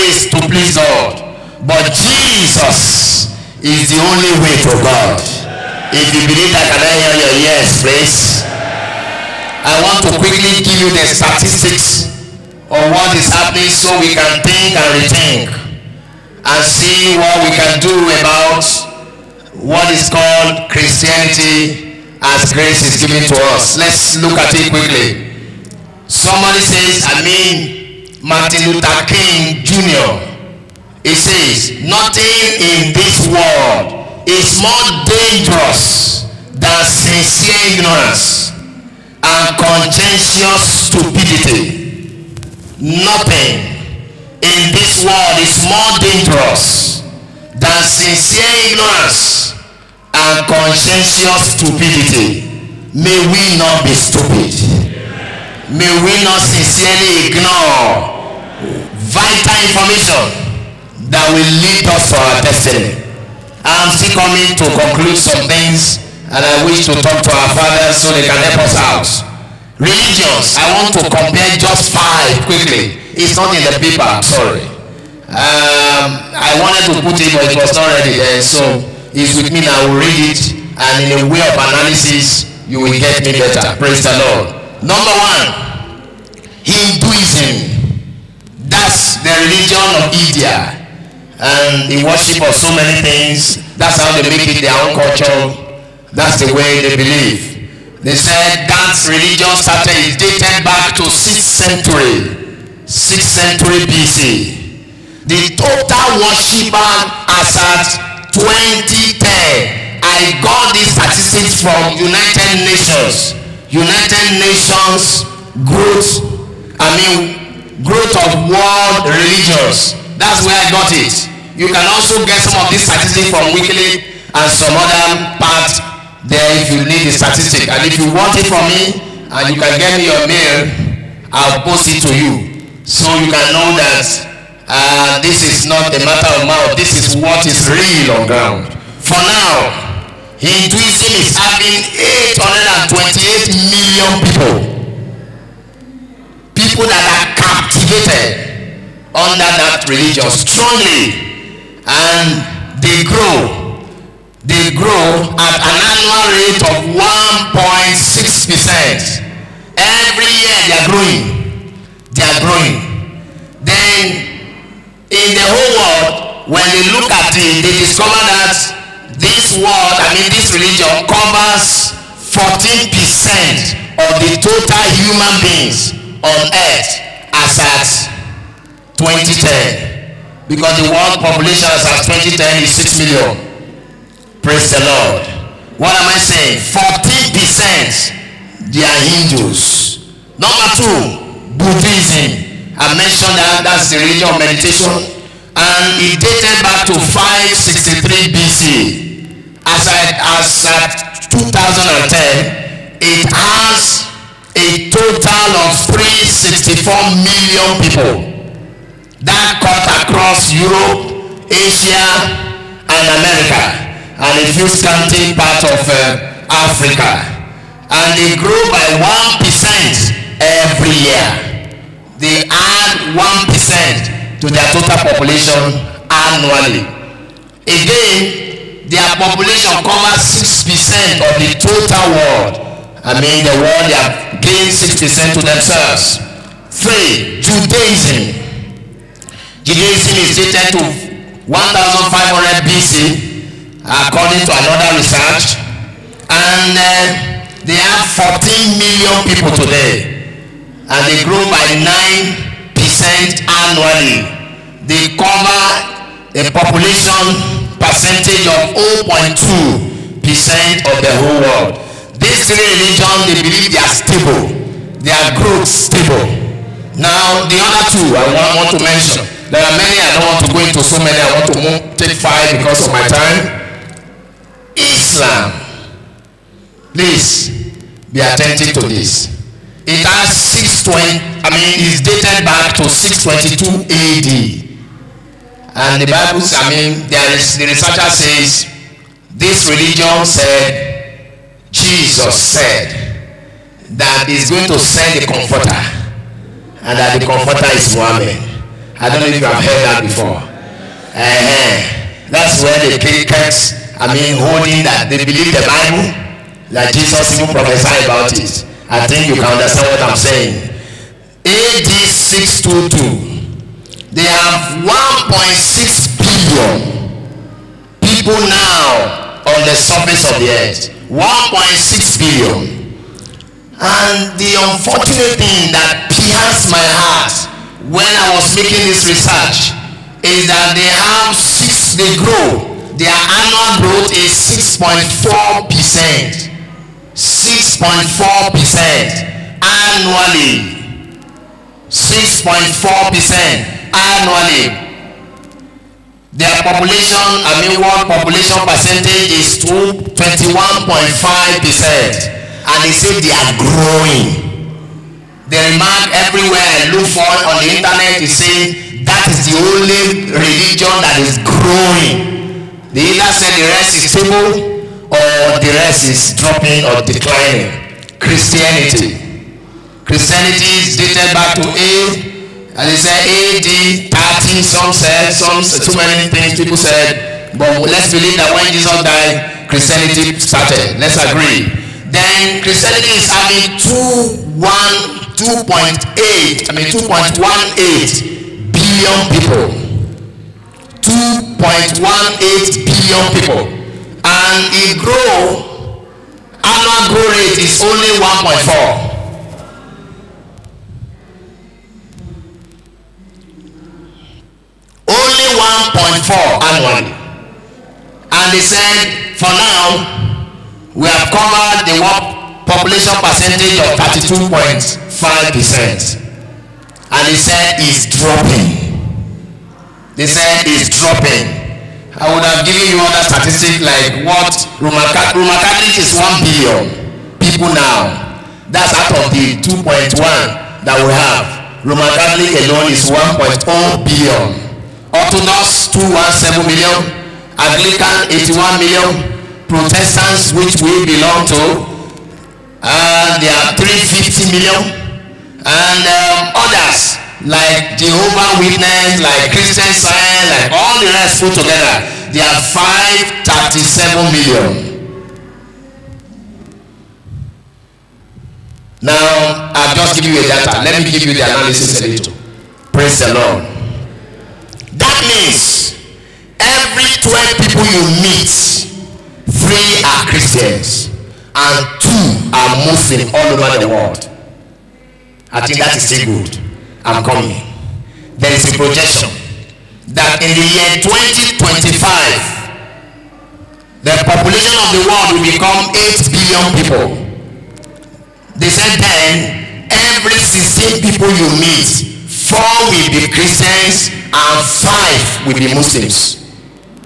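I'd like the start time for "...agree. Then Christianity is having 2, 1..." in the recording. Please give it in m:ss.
6:21.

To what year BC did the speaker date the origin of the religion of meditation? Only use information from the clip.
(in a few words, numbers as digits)
563 BC.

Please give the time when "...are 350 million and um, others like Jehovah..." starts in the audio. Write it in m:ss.
7:23.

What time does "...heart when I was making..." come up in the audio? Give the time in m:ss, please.
5:26.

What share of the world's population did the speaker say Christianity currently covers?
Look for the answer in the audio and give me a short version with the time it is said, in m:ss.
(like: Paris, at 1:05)
32.5%, at 6:53.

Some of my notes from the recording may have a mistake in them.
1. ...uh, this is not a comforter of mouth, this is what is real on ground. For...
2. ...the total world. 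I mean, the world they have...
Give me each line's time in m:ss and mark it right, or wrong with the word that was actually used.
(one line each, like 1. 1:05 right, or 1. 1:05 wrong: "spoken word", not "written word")
1. 2:14 wrong: "matter", not "comforter"
2. 3:51 right.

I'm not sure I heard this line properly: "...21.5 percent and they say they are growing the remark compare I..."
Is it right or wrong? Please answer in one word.
wrong.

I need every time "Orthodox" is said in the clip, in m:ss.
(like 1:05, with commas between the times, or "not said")
7:15.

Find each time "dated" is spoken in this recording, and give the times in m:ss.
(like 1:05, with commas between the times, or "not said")
1:40, 3:16, 4:00, 4:42, 6:10.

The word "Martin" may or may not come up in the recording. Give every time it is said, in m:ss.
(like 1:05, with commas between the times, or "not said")
0:28.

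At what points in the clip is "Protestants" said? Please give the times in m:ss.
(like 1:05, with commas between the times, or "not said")
7:19.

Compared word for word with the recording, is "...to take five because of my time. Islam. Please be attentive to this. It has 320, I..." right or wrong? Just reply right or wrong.
wrong.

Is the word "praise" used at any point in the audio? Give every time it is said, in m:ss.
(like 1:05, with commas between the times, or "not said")
1:23, 3:04, 7:42.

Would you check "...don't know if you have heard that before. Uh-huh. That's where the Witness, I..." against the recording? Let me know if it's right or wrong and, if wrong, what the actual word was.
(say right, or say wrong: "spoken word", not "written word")
wrong: "Christians", not "Witness".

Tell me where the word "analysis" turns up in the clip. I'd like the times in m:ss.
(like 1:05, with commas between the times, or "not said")
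1:21, 7:41.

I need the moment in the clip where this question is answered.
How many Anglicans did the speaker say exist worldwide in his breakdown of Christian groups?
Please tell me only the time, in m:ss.
7:18.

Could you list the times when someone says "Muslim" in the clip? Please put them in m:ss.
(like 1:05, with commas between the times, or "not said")
7:52, 8:15.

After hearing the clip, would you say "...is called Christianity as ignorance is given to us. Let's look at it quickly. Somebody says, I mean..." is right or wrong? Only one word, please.
wrong.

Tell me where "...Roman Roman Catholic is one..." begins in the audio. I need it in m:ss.
7:04.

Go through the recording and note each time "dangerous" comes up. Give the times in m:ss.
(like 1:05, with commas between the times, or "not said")
0:35, 0:45.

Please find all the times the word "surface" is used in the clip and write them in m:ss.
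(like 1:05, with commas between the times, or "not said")
5:19.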